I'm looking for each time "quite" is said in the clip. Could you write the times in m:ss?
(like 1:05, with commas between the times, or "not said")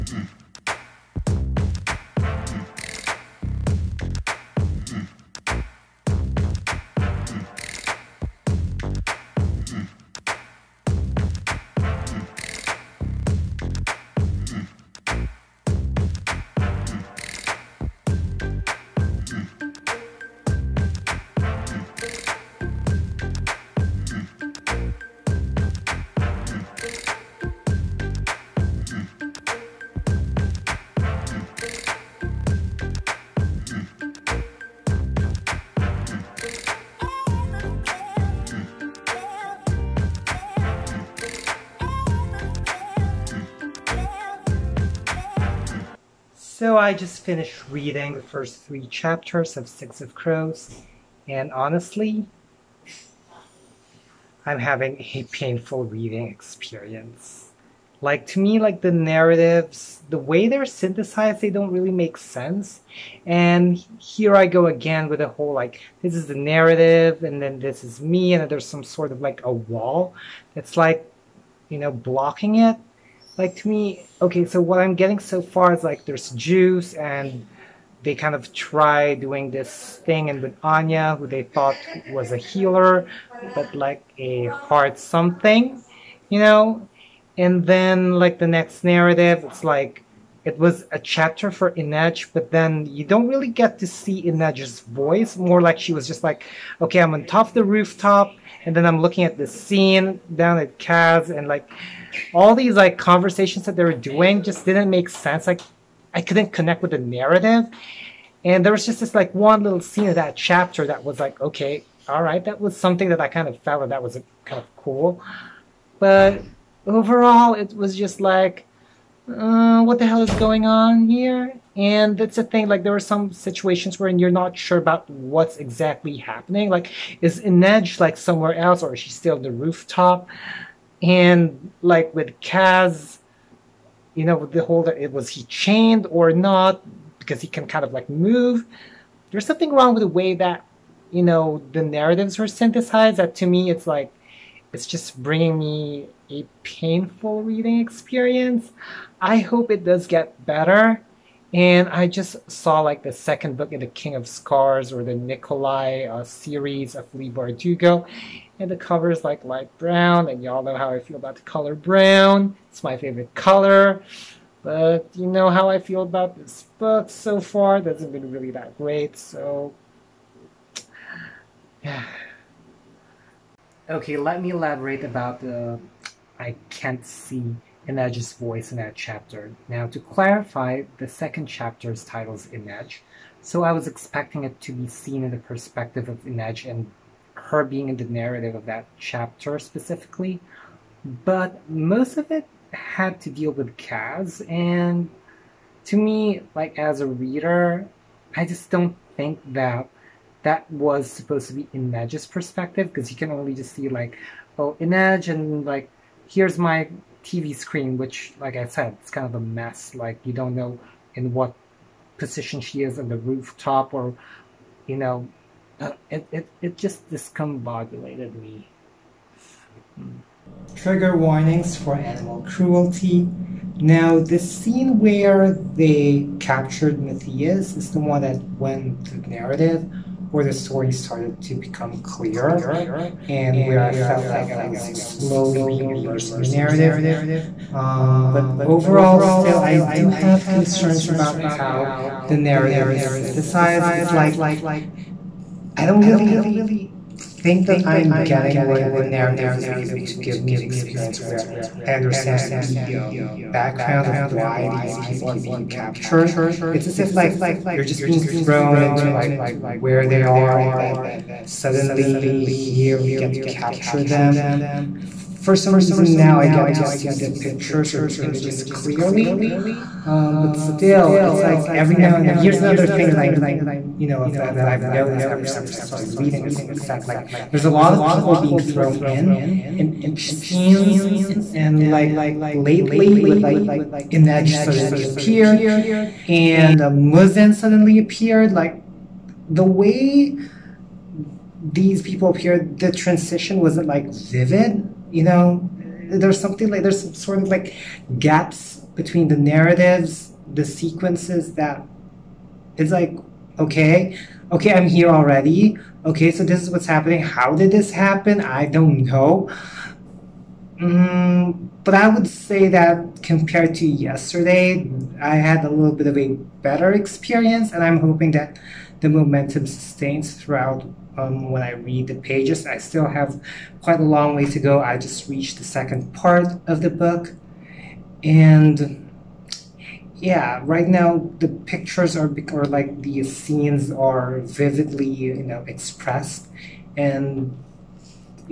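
5:23.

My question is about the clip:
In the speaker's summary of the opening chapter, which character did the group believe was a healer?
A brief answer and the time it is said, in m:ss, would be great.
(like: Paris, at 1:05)
Anya, at 1:20.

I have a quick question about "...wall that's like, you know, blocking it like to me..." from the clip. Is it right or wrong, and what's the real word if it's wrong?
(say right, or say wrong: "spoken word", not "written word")
right.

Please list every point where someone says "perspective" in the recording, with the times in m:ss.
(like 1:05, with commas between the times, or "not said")
3:05, 3:22.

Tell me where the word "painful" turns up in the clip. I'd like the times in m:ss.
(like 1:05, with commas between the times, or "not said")
0:55, 2:26.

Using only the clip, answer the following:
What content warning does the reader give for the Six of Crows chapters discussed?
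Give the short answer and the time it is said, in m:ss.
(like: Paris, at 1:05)
Animal cruelty, at 3:41.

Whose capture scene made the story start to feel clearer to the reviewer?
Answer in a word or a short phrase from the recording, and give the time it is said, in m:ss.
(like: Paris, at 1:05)
Matthias, at 3:47.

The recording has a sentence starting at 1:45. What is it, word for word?
Like I couldn't connect with the narrative.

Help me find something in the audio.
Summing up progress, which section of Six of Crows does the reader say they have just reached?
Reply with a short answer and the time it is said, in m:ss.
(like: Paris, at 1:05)
Second part, at 5:25.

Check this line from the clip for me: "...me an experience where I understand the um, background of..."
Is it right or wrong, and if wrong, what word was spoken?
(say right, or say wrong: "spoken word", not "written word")
right.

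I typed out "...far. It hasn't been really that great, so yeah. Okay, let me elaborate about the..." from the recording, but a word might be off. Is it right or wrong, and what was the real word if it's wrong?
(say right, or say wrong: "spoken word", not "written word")
right.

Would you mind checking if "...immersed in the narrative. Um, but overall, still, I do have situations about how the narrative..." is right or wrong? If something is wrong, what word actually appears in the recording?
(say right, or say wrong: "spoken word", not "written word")
wrong: "concerns", not "situations".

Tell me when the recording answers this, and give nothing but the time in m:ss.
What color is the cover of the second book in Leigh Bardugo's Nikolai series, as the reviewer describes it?
2:39.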